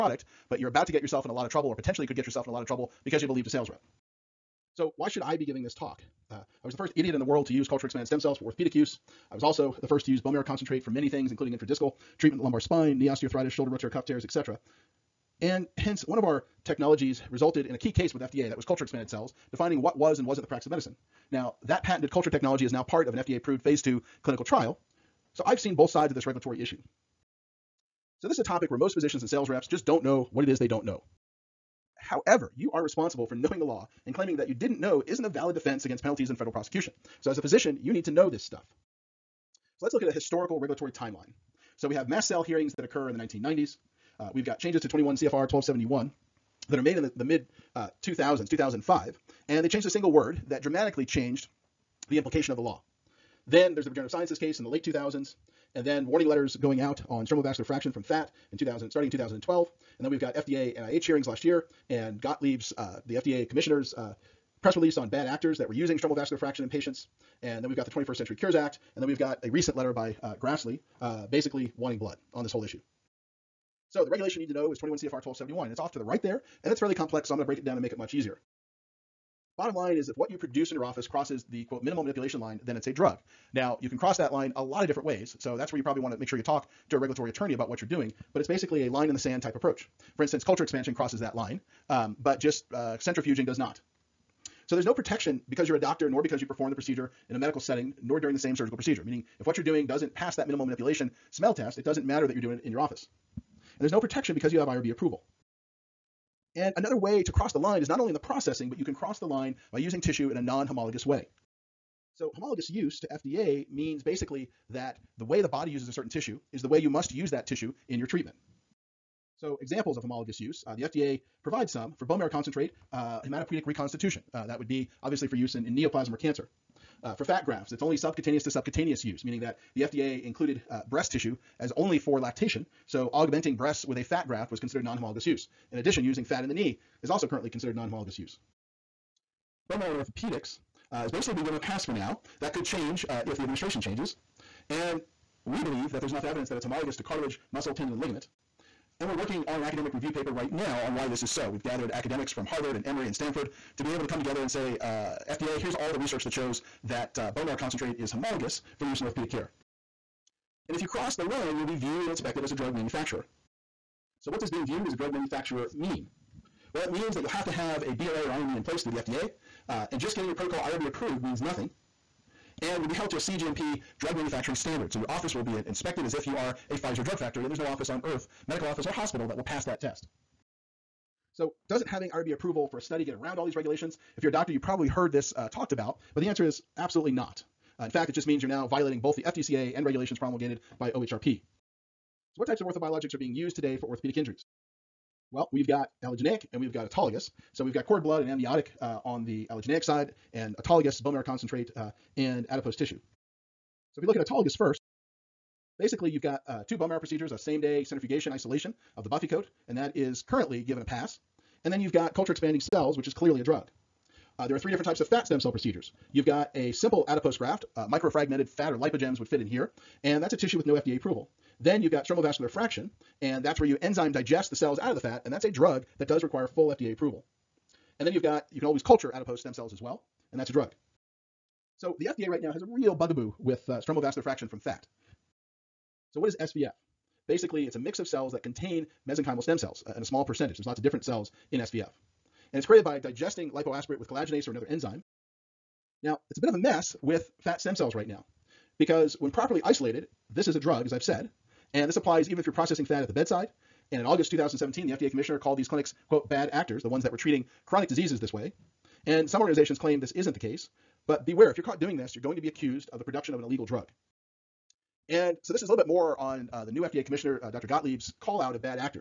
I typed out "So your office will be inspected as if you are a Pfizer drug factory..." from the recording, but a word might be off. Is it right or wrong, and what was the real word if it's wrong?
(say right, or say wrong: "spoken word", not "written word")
right.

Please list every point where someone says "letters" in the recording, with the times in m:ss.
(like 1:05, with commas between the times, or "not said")
0:56, 1:09.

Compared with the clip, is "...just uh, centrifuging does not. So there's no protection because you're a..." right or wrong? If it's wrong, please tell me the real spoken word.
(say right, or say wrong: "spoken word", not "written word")
right.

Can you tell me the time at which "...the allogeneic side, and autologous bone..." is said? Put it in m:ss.
3:19.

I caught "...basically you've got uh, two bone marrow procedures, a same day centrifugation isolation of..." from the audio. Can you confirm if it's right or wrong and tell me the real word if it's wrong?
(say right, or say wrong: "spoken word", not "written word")
right.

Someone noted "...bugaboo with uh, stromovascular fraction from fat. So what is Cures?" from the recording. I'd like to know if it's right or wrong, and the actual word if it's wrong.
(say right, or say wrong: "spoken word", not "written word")
wrong: "SVF", not "Cures".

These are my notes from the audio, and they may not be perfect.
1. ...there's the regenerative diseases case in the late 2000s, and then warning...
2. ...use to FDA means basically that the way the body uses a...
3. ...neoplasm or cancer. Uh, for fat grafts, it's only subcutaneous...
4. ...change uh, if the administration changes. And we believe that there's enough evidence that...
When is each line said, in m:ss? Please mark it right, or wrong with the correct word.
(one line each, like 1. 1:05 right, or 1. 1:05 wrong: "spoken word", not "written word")
1. 0:53 wrong: "sciences", not "diseases"
2. 1:52 right
3. 2:05 right
4. 2:22 right.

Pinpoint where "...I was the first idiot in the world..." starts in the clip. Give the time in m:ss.
0:06.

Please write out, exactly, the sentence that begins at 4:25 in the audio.
And so this is a little bit more on uh, the new FDA commissioner, uh, Dr.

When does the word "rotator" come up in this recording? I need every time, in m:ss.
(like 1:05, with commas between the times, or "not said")
0:13.